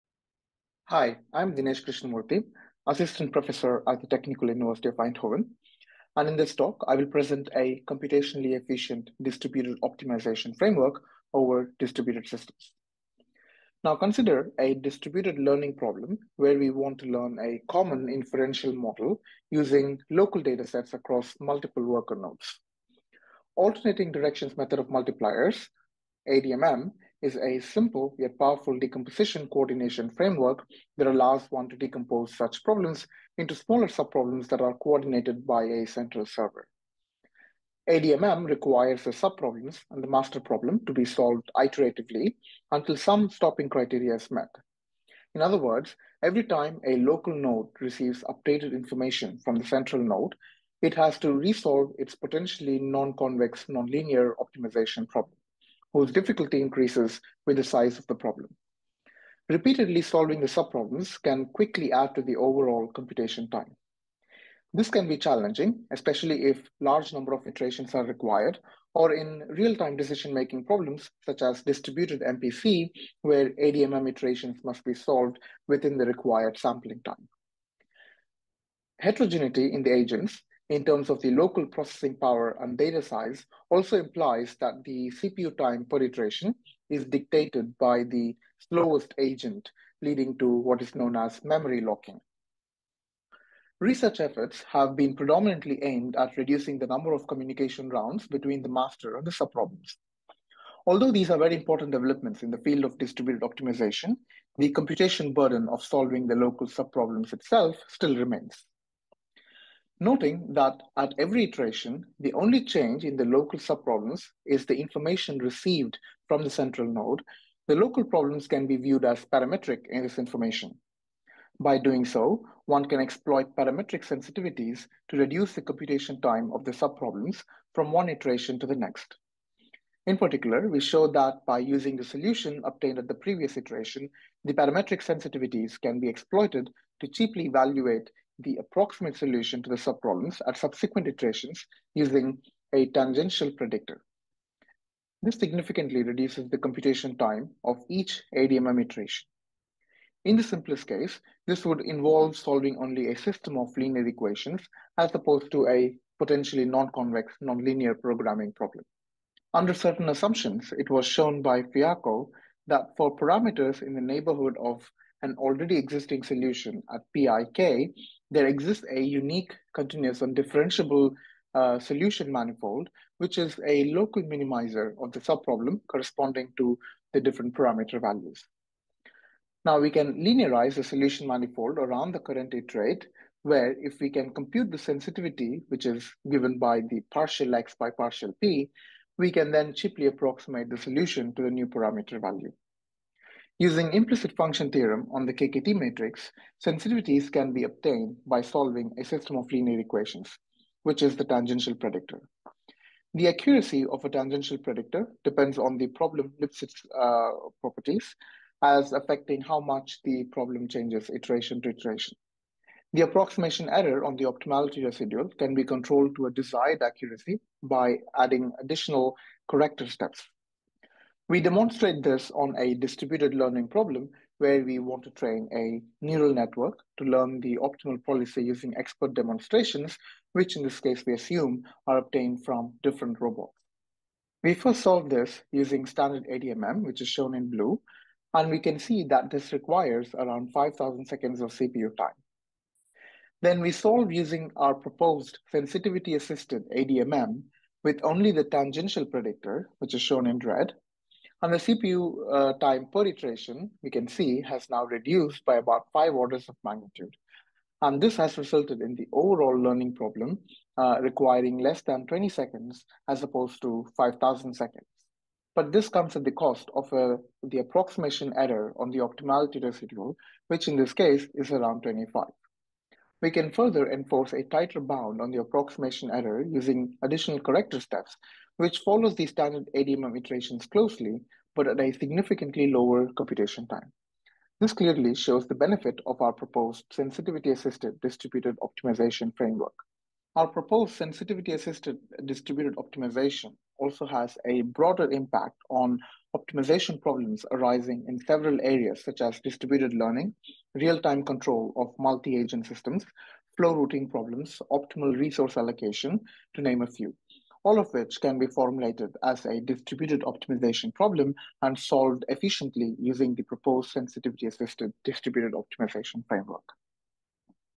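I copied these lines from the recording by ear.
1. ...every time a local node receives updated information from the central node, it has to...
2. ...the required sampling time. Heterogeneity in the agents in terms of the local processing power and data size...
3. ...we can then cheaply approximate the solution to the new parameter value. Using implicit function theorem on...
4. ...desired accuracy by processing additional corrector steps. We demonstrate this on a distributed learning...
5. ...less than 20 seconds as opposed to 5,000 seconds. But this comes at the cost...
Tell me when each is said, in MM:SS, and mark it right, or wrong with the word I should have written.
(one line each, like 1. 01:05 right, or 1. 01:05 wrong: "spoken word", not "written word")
1. 00:46 right
2. 01:15 right
3. 03:09 right
4. 03:36 wrong: "adding", not "processing"
5. 04:21 right.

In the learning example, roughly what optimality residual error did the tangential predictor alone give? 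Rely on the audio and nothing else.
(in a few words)
25.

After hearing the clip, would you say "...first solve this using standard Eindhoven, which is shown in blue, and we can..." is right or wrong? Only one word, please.
wrong.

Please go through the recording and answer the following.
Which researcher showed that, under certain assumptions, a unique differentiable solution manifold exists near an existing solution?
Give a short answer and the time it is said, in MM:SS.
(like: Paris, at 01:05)
Fiacco, at 02:41.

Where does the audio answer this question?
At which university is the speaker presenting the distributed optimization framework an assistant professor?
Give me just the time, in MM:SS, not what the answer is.
00:04.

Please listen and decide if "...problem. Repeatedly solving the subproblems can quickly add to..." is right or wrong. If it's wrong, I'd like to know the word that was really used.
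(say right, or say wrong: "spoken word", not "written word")
right.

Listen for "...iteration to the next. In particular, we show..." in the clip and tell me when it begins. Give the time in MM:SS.
02:08.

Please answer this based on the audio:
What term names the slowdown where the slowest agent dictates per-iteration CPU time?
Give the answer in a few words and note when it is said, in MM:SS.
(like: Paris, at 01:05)
memory locking, at 01:31.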